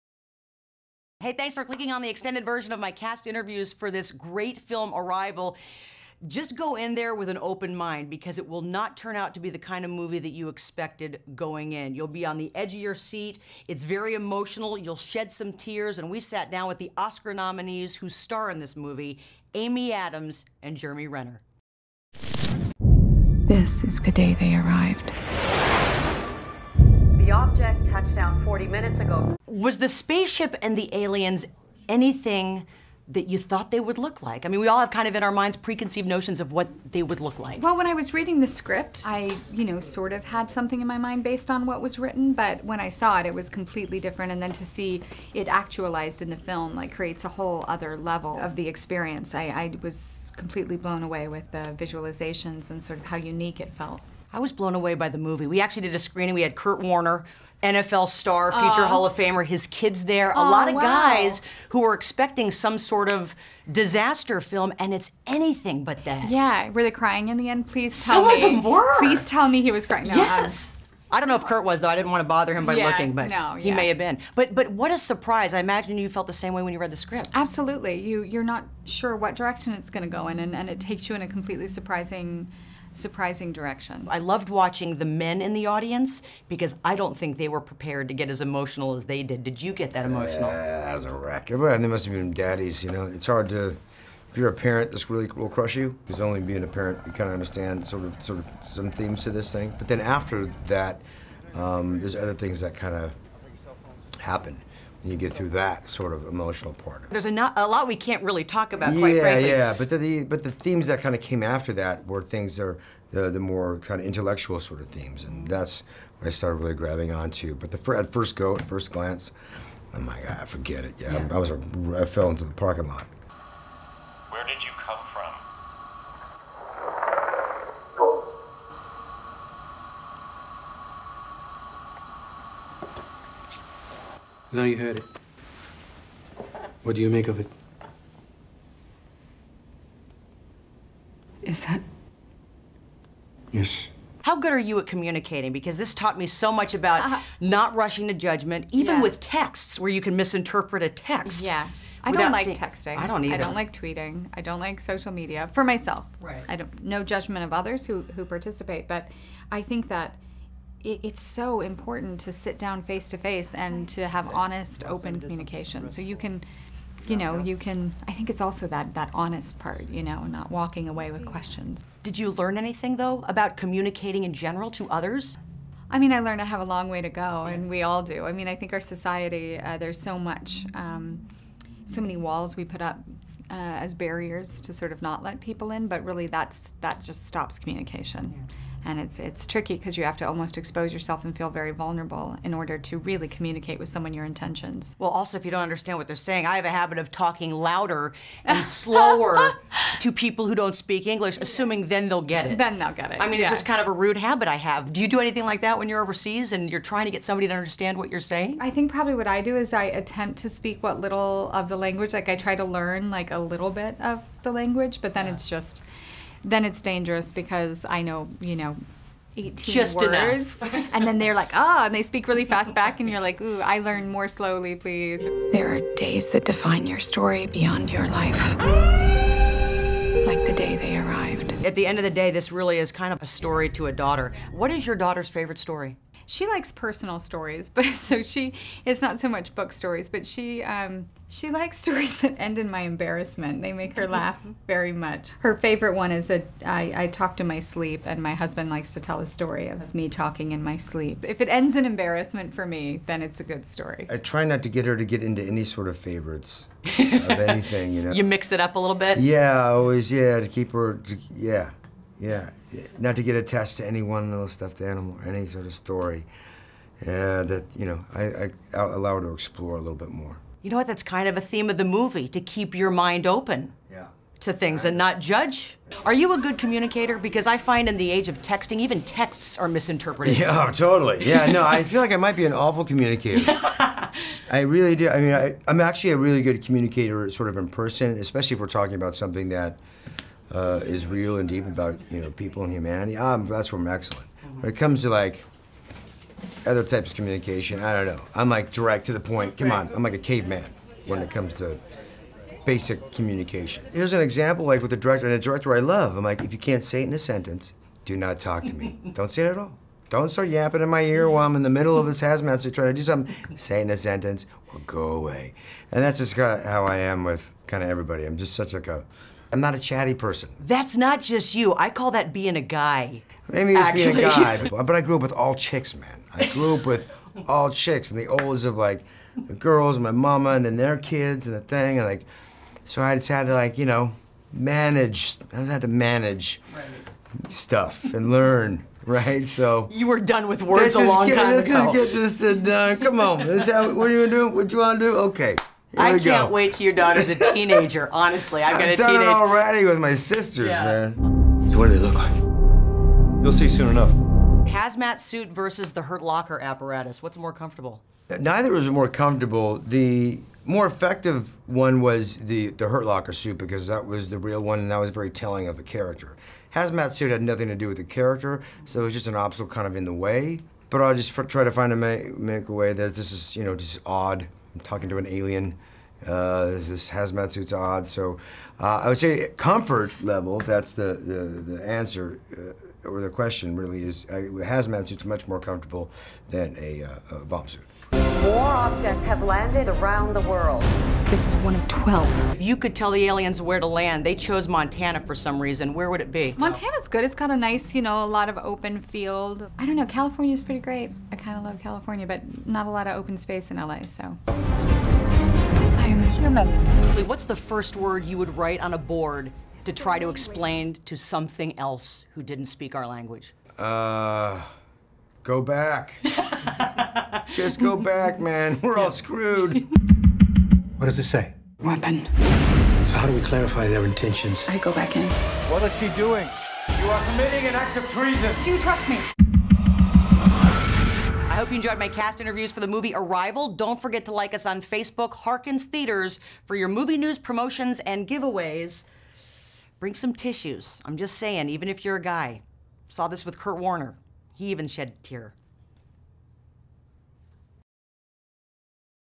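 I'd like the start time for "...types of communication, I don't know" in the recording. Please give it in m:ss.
4:56.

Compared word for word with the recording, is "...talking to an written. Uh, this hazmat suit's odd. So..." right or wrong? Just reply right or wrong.
wrong.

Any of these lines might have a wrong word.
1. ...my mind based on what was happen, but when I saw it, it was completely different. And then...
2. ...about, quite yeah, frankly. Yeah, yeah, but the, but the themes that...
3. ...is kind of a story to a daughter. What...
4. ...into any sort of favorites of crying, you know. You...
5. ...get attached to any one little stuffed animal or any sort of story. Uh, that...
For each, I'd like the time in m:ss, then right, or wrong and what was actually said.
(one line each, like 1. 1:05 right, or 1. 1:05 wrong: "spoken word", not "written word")
1. 0:40 wrong: "written", not "happen"
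2. 1:48 right
3. 3:52 right
4. 4:15 wrong: "anything", not "crying"
5. 4:23 right.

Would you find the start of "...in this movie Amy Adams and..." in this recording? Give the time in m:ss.
0:18.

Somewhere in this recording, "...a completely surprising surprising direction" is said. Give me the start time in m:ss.
1:21.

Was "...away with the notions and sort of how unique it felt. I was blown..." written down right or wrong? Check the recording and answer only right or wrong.
wrong.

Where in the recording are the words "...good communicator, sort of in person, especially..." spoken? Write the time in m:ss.
4:46.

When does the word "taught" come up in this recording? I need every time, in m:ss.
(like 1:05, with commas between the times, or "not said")
2:25.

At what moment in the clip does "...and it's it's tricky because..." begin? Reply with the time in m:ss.
3:08.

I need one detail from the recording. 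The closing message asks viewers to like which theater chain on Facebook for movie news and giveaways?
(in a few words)
Harkins Theatres.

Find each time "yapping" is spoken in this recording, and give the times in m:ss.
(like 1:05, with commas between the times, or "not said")
5:10.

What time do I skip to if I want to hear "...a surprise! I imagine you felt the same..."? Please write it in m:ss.
1:14.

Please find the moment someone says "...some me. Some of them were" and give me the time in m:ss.
1:08.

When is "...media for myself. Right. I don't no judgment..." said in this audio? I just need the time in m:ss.
2:35.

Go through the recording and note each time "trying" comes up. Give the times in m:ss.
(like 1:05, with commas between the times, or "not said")
3:26, 5:12.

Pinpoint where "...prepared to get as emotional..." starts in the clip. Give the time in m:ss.
1:27.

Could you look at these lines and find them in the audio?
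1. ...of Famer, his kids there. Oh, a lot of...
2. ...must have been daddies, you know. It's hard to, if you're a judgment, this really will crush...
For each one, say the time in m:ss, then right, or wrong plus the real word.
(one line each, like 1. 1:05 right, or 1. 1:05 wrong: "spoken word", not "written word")
1. 0:59 right
2. 1:31 wrong: "parent", not "judgment".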